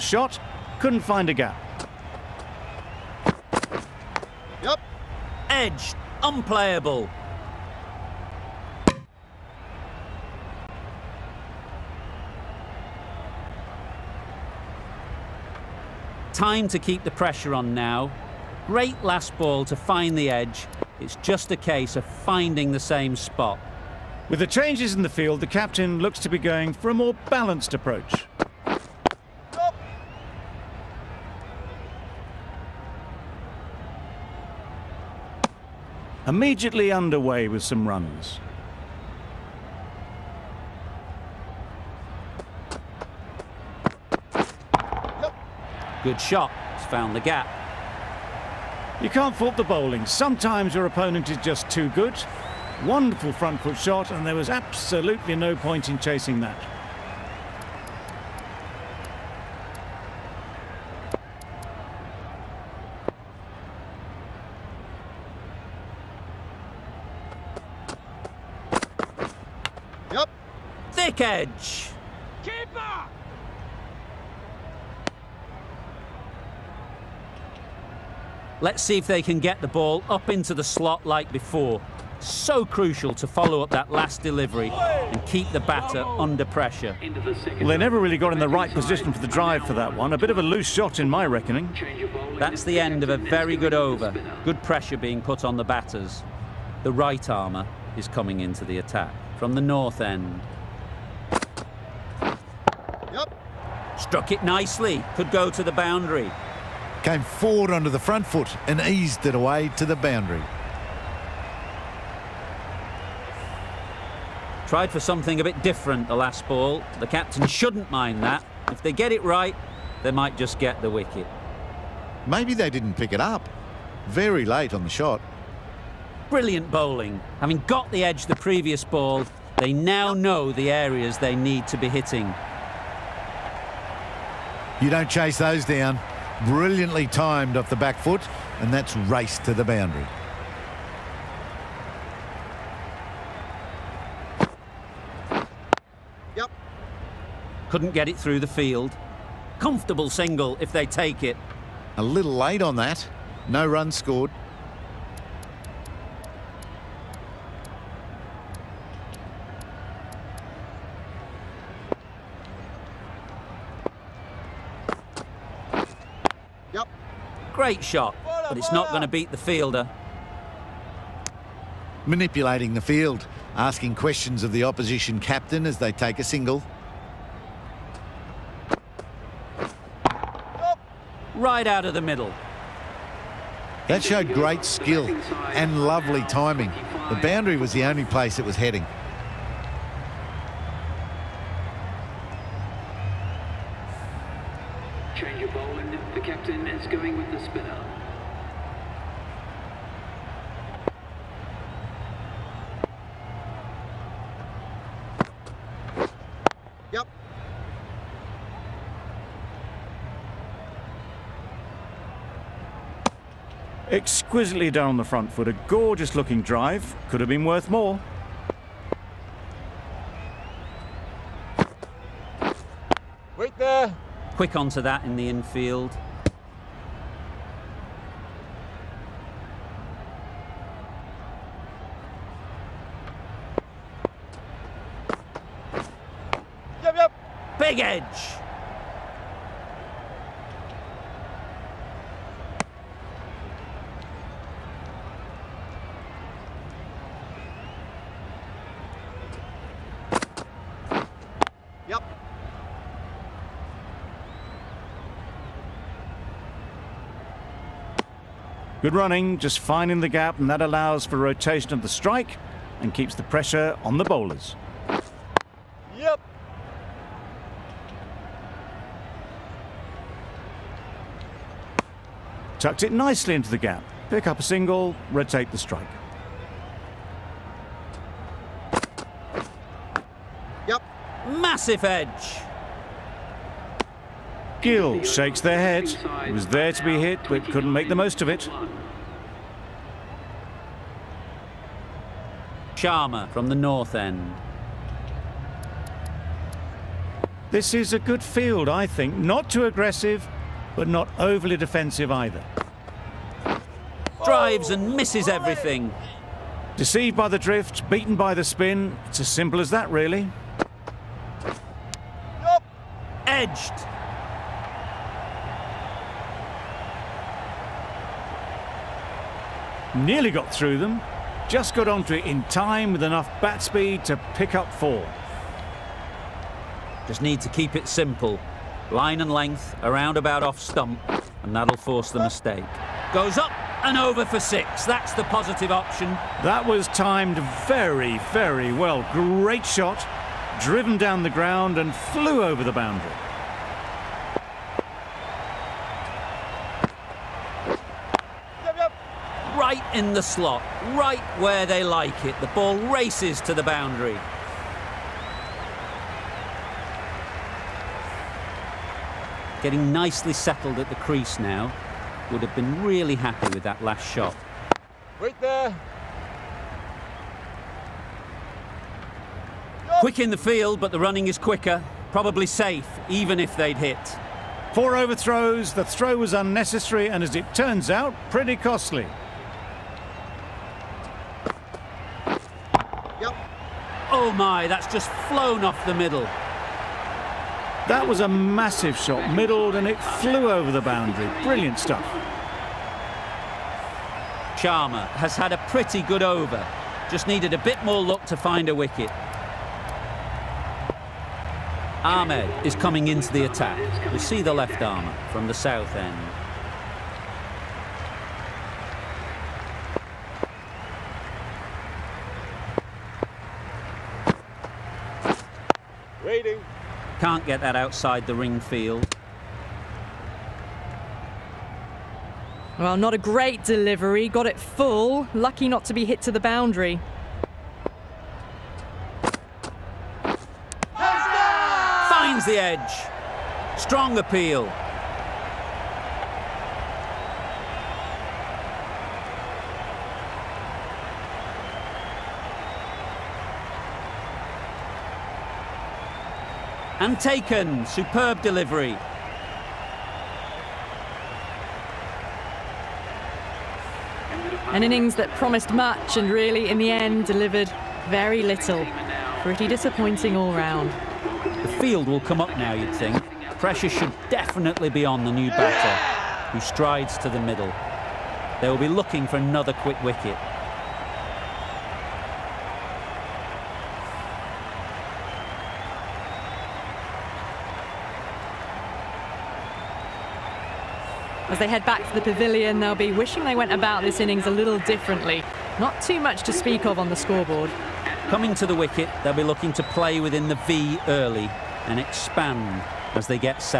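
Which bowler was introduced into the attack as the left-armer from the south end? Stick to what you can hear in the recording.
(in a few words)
Ahmed.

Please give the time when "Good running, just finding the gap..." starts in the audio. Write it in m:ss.
4:18.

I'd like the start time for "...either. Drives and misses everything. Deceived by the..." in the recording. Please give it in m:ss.
5:02.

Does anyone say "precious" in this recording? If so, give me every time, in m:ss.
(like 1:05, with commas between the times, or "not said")
not said.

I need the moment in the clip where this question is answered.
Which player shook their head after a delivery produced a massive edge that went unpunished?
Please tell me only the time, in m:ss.
4:44.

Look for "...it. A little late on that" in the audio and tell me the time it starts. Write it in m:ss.
2:31.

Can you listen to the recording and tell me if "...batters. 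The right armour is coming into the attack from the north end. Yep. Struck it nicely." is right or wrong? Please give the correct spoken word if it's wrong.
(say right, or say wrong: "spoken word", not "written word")
right.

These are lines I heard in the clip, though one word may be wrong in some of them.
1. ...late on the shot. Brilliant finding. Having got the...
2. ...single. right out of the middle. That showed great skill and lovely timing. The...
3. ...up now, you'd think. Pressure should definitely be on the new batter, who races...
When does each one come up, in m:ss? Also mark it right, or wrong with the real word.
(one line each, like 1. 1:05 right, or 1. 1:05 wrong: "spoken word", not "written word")
1. 2:04 wrong: "bowling", not "finding"
2. 2:56 right
3. 7:42 wrong: "strides", not "races".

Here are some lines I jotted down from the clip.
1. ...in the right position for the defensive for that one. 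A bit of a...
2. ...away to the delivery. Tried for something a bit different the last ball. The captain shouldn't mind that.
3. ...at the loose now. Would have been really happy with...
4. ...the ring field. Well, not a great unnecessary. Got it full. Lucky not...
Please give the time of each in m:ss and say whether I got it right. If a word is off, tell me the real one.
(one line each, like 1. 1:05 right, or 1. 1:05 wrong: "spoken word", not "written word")
1. 1:28 wrong: "drive", not "defensive"
2. 1:49 wrong: "boundary", not "delivery"
3. 6:00 wrong: "crease", not "loose"
4. 6:58 wrong: "delivery", not "unnecessary".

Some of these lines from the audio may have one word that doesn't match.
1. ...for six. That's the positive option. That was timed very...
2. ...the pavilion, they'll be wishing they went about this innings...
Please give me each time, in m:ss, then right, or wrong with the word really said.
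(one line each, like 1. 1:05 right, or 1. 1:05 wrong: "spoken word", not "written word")
1. 5:34 right
2. 8:02 right.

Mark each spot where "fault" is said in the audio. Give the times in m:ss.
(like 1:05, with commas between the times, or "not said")
0:49.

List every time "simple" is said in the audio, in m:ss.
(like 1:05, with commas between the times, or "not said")
5:09, 5:27.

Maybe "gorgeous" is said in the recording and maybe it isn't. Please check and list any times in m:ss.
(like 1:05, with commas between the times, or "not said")
3:35.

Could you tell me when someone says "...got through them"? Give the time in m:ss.
5:20.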